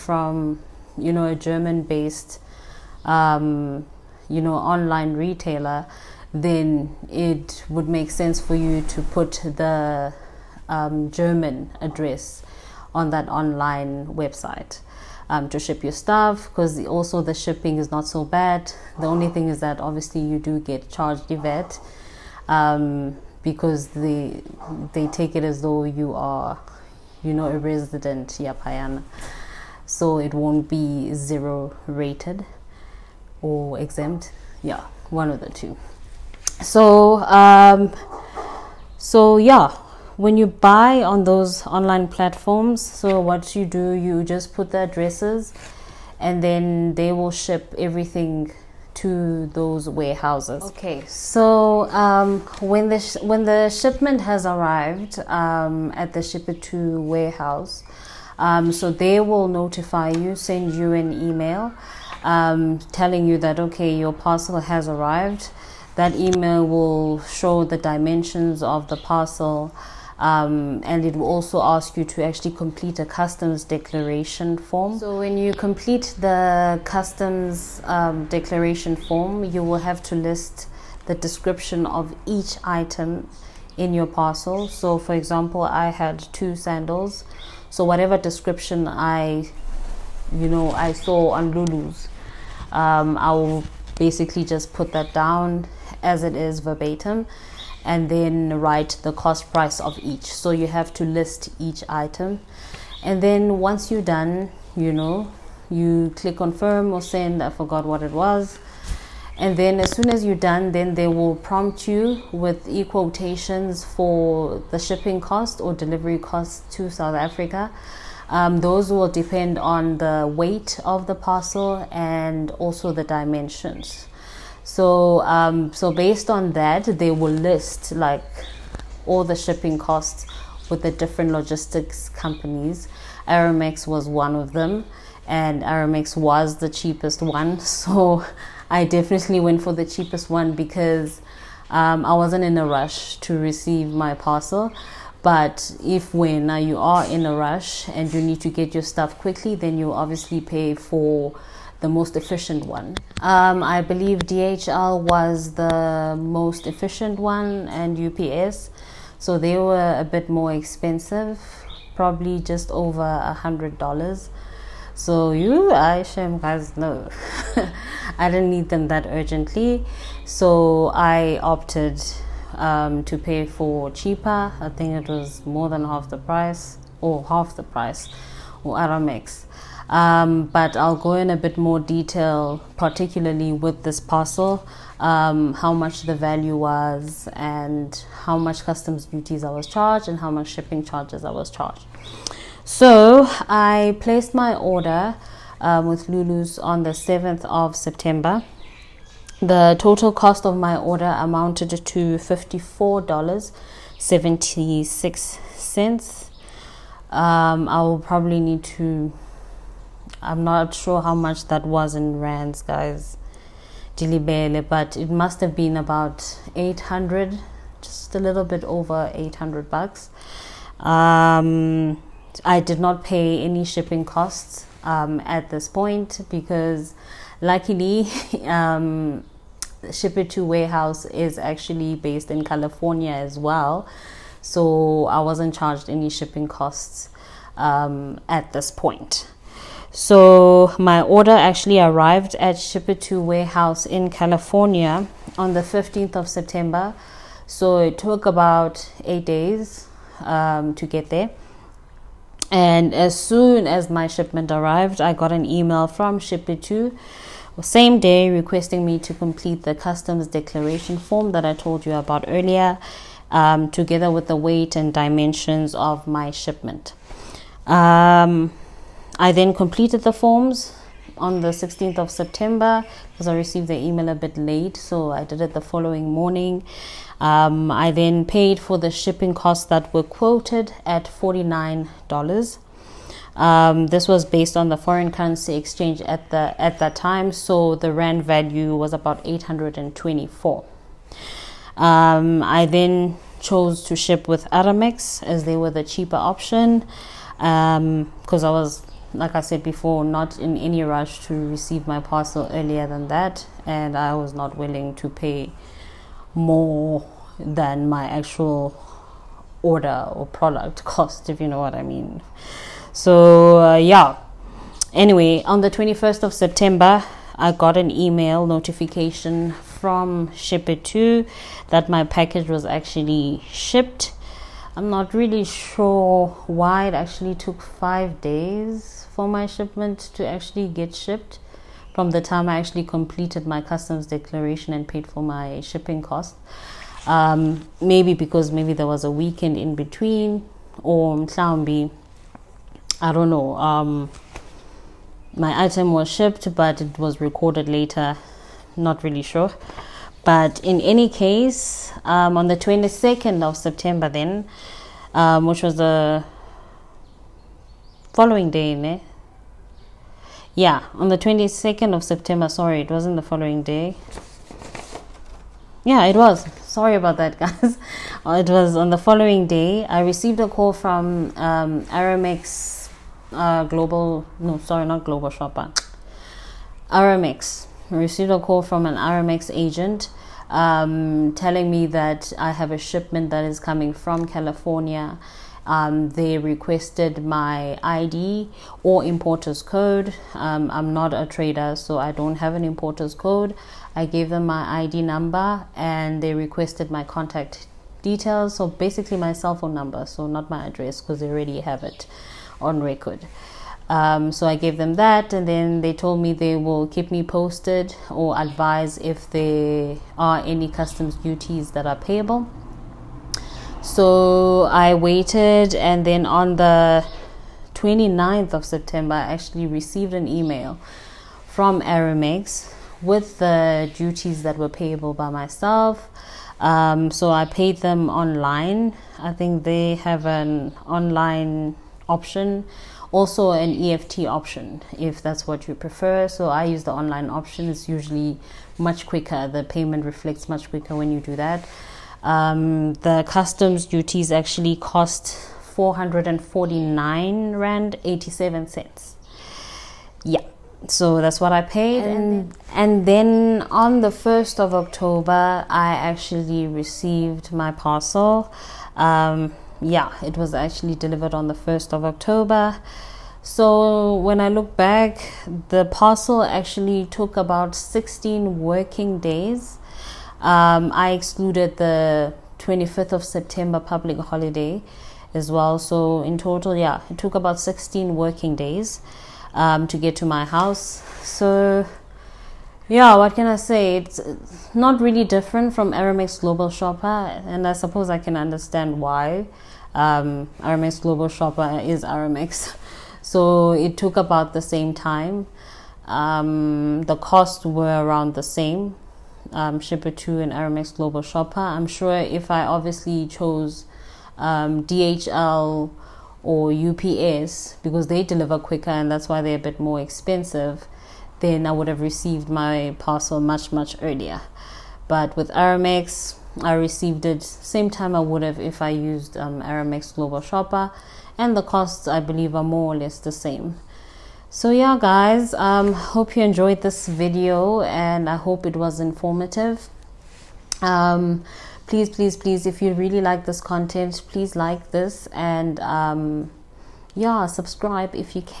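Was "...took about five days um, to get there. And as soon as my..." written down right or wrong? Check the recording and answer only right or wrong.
wrong.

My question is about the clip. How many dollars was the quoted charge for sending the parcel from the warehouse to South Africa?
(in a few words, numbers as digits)
$49.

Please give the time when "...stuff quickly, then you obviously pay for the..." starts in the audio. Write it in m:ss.
2:28.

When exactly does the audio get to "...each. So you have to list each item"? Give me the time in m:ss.
1:40.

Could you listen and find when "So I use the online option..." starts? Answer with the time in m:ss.
7:16.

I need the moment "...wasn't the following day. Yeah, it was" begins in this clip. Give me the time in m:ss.
6:02.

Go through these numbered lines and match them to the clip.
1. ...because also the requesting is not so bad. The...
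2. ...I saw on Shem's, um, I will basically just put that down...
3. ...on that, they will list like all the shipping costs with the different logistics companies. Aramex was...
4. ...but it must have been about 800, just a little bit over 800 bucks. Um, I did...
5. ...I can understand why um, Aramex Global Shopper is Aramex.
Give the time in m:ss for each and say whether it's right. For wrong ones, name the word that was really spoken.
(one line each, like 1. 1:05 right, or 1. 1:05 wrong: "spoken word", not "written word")
1. 0:16 wrong: "shipping", not "requesting"
2. 1:30 wrong: "Lulu", not "Shem"
3. 2:06 right
4. 3:34 right
5. 8:08 right.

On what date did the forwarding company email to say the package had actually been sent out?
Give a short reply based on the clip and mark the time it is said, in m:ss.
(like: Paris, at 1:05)
21 September, at 5:15.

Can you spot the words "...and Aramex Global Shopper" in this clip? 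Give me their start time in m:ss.
8:20.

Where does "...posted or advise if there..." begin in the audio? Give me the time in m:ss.
6:47.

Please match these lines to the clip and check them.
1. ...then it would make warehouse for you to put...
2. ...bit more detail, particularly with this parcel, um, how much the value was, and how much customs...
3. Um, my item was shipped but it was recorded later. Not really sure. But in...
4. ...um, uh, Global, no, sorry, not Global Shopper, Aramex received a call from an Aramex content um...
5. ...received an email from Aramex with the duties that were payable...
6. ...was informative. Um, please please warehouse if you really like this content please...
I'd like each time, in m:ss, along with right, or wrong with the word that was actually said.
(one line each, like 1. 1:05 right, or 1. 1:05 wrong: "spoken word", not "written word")
1. 0:06 wrong: "sense", not "warehouse"
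2. 3:01 right
3. 5:43 right
4. 6:11 wrong: "agent", not "content"
5. 6:59 right
6. 8:48 wrong: "please", not "warehouse".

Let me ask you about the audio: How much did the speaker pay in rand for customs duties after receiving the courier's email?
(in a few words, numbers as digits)
R449.87.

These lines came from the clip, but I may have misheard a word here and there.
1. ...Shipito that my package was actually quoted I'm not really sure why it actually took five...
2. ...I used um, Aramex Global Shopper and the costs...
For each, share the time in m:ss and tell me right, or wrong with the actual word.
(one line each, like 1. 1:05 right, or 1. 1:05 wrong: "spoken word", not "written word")
1. 5:20 wrong: "shipped", not "quoted"
2. 8:38 right.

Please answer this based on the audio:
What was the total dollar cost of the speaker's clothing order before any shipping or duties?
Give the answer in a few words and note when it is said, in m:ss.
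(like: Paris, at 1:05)
$54.76, at 3:21.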